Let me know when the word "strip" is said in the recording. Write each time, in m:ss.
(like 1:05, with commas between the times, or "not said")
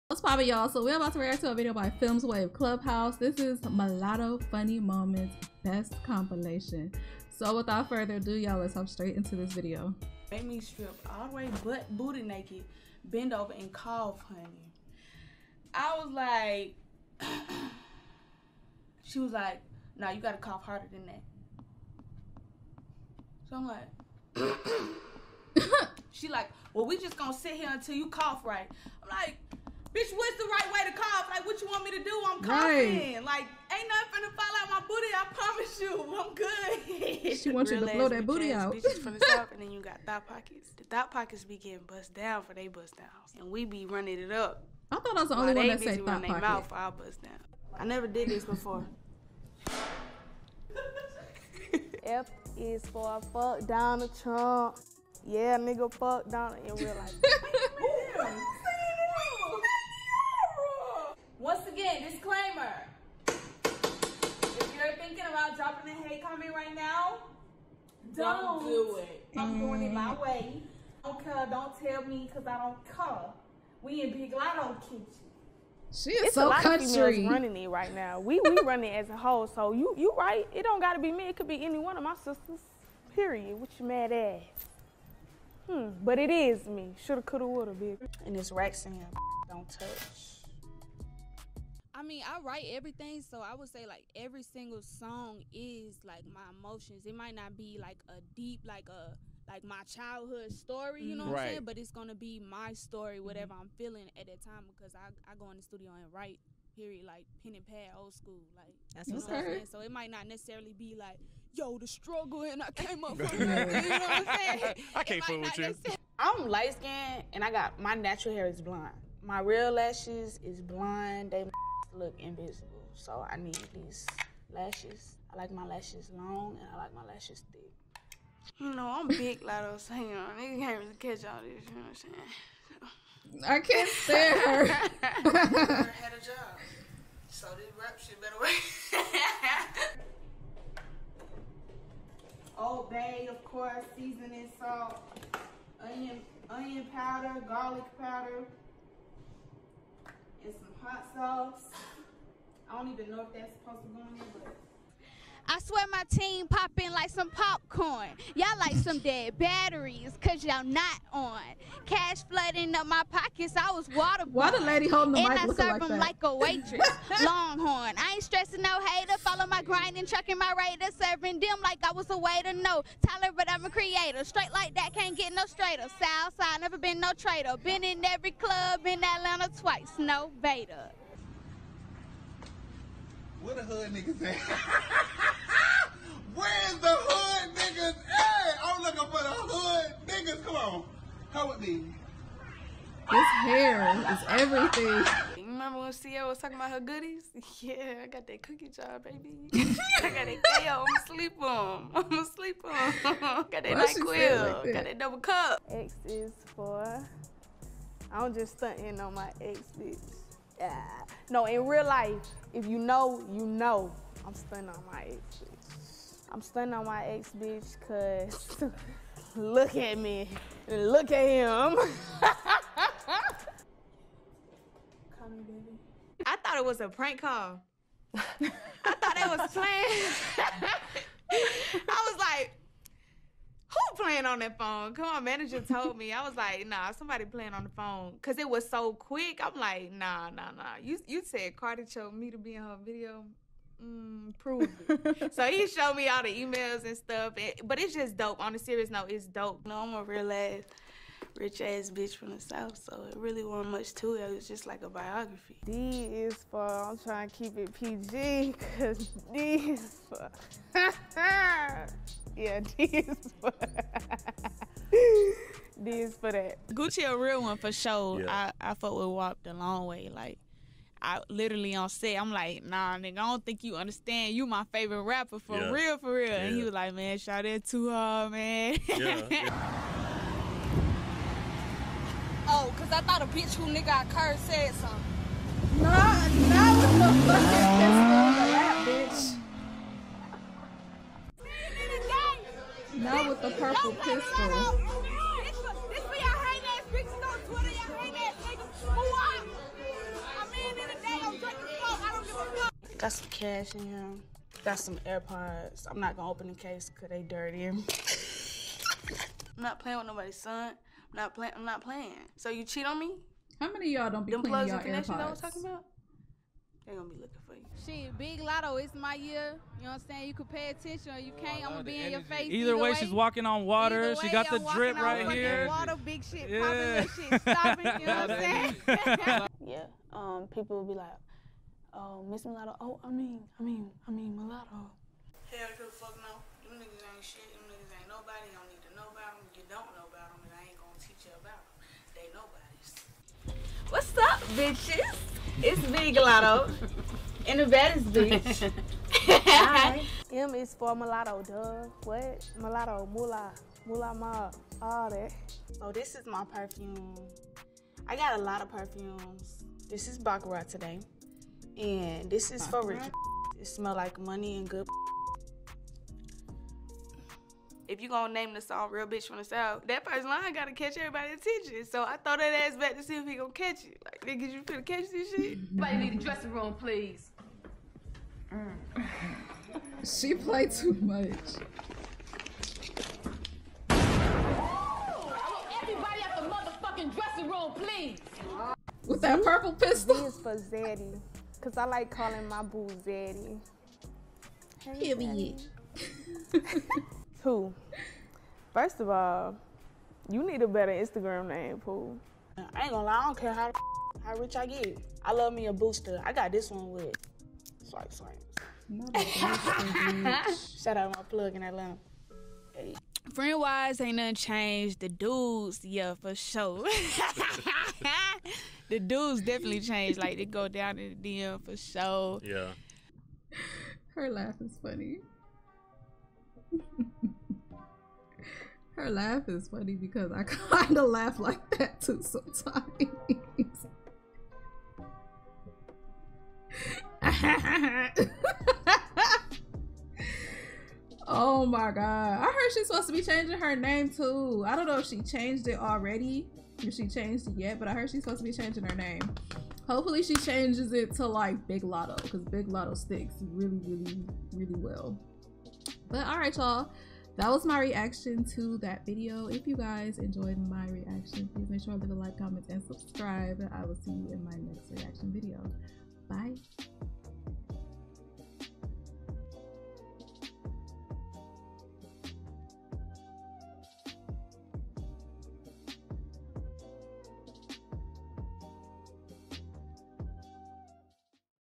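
0:10.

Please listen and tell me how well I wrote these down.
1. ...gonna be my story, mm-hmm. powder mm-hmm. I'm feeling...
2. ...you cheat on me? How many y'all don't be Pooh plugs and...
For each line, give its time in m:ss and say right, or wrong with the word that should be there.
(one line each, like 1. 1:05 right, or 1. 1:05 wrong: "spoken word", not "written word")
1. 1:41 wrong: "whatever", not "powder"
2. 5:12 wrong: "Them", not "Pooh".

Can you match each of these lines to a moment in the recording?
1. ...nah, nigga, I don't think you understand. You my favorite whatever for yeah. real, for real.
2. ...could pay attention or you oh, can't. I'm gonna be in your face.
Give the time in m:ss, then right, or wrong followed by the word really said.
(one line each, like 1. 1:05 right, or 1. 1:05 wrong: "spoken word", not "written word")
1. 4:32 wrong: "rapper", not "whatever"
2. 5:20 right.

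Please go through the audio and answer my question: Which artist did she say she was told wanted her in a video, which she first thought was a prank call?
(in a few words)
Cardi.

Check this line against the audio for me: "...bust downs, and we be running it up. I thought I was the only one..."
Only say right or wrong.
right.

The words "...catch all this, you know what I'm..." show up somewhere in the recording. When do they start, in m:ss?
2:10.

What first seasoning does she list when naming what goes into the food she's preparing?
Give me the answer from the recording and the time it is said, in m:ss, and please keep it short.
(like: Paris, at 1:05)
Old Bay, at 2:22.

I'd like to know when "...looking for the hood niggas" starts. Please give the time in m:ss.
3:08.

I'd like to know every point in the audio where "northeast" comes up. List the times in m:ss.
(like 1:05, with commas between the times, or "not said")
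not said.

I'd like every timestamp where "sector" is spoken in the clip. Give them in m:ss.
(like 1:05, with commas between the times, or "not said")
not said.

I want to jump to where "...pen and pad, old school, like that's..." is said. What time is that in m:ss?
1:47.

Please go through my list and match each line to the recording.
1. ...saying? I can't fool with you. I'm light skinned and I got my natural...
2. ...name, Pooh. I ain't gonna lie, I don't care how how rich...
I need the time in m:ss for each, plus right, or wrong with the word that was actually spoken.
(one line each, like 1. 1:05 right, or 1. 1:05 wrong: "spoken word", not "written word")
1. 1:54 right
2. 6:41 right.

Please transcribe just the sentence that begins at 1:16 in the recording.
Of females running it right now.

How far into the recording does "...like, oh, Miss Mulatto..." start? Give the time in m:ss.
5:30.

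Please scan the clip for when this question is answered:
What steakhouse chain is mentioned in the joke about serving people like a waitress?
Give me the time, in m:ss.
2:47.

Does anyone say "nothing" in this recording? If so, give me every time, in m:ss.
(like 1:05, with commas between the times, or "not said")
0:33, 6:54.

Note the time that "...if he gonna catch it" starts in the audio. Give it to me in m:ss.
6:13.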